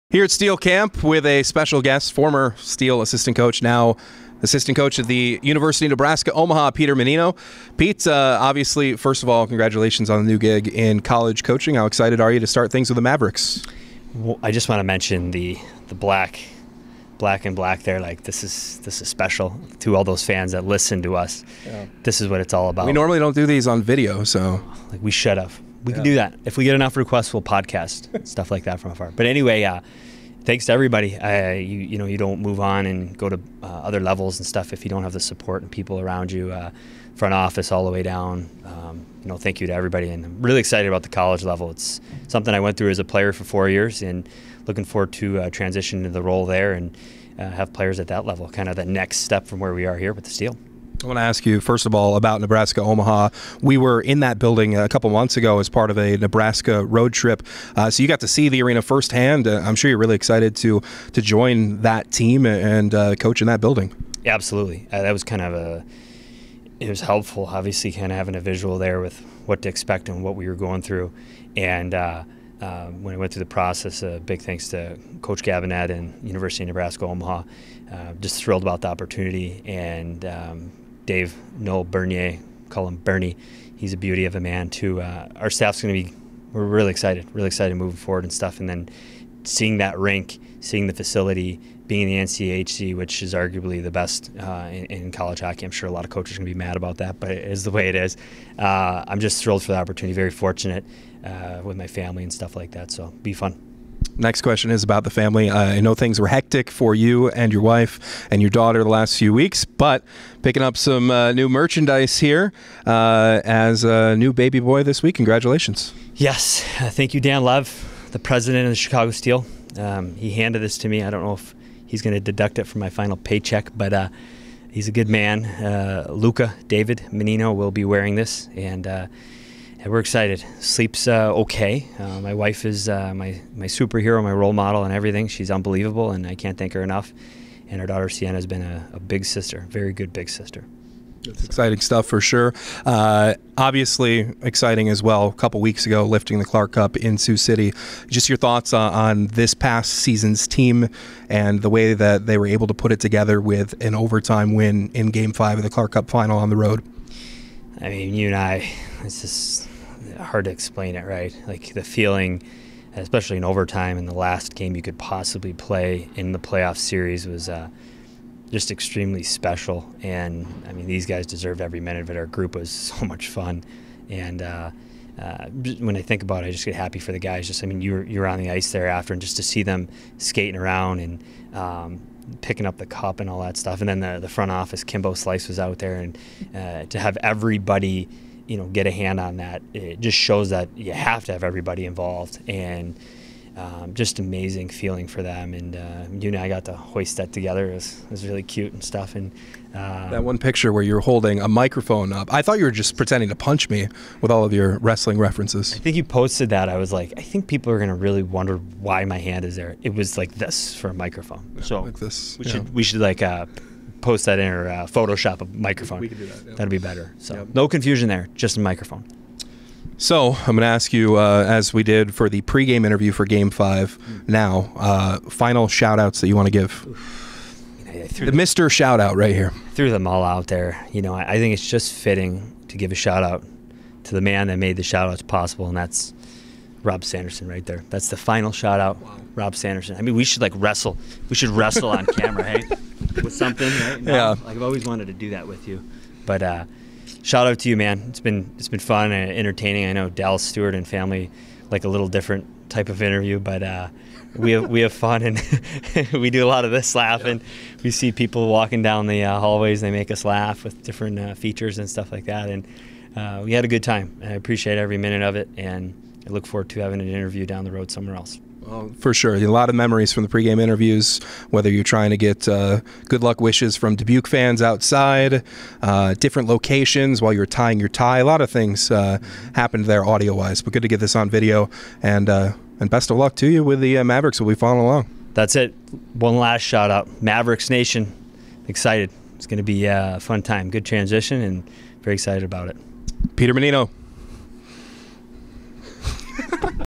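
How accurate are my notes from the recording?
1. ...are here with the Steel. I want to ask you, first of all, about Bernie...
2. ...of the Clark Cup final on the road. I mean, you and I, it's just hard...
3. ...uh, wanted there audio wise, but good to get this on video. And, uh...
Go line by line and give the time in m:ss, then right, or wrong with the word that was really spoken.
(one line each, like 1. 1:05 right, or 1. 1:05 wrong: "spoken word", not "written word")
1. 0:49 wrong: "Nebraska", not "Bernie"
2. 2:35 right
3. 4:38 wrong: "happened", not "wanted".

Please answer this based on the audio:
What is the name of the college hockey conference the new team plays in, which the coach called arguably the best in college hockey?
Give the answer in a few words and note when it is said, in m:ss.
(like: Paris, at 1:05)
NCHC, at 1:32.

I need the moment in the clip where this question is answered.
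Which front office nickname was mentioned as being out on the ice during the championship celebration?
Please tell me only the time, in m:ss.
3:04.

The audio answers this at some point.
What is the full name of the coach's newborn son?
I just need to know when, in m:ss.
2:06.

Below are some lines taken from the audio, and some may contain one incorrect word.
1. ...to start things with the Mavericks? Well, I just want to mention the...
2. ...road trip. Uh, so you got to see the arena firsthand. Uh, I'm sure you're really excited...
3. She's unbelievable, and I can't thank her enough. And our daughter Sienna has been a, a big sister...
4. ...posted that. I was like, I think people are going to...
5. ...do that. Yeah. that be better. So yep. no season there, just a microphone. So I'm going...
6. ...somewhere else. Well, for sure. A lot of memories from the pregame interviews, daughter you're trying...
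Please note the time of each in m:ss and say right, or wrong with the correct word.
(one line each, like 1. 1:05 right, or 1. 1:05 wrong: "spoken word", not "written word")
1. 0:12 right
2. 0:56 right
3. 2:15 right
4. 3:26 right
5. 3:36 wrong: "confusion", not "season"
6. 4:27 wrong: "whether", not "daughter".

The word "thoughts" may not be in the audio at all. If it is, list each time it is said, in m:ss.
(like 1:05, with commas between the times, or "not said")
2:28, 3:22.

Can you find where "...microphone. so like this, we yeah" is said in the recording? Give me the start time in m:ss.
3:30.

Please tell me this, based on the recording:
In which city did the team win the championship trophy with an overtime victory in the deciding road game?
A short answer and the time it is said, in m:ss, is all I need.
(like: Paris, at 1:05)
Sioux City, at 2:27.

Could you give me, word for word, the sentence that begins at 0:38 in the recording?
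Um, you know, thank you to everybody.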